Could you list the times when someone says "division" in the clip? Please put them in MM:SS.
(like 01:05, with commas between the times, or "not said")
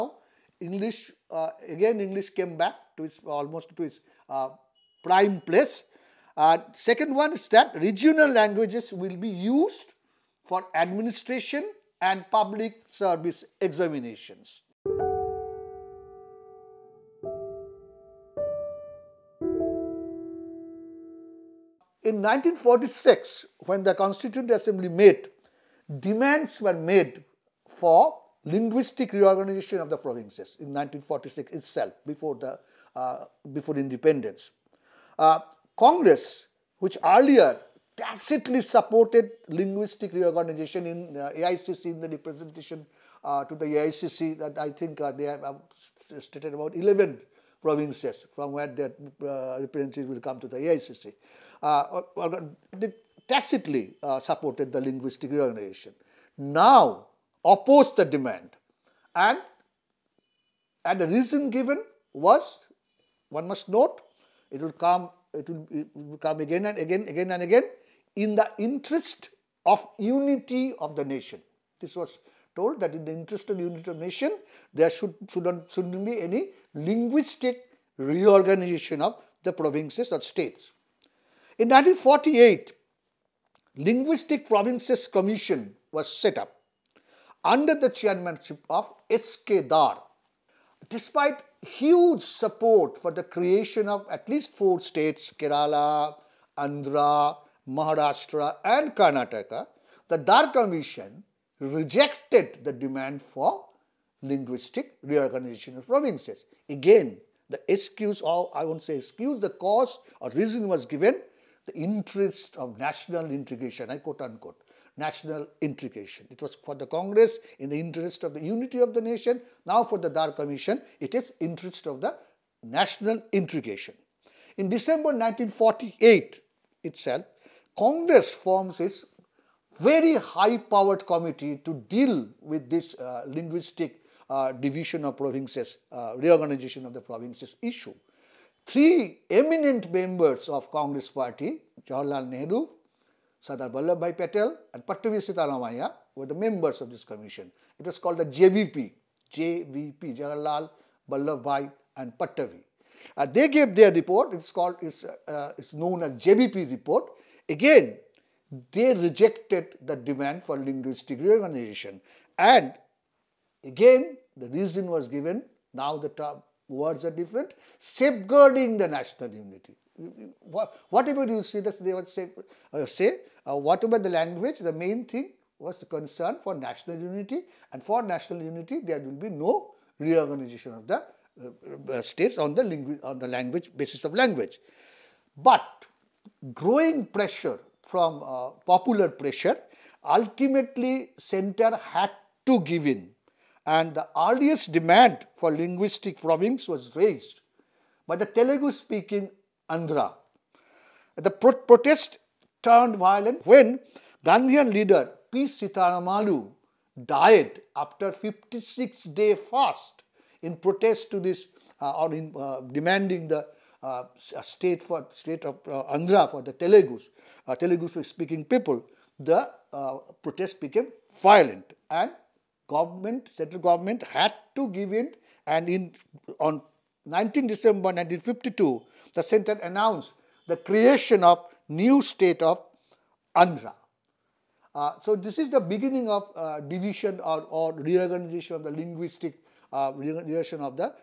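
02:14, 03:56.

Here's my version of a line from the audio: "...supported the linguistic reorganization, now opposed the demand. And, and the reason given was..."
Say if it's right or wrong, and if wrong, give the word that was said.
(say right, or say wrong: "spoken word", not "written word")
right.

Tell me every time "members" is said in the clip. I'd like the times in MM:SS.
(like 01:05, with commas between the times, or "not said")
02:19, 02:26.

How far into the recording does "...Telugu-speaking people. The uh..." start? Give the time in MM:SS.
03:37.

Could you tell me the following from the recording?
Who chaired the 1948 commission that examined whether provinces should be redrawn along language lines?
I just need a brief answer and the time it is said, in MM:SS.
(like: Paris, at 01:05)
S.K. Dhar, at 01:29.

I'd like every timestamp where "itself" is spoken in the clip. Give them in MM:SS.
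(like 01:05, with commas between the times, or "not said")
00:31, 02:06.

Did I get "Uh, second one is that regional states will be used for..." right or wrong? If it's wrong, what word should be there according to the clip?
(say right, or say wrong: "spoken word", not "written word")
wrong: "languages", not "states".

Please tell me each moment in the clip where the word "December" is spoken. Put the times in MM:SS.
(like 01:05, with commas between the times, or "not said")
02:04, 03:47.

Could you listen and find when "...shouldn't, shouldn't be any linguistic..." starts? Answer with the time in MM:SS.
01:15.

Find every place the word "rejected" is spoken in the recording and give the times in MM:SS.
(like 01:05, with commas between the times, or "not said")
01:41, 02:38.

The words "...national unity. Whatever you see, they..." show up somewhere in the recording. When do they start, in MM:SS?
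02:48.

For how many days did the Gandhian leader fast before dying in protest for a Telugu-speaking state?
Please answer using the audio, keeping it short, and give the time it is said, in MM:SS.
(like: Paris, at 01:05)
56, at 03:28.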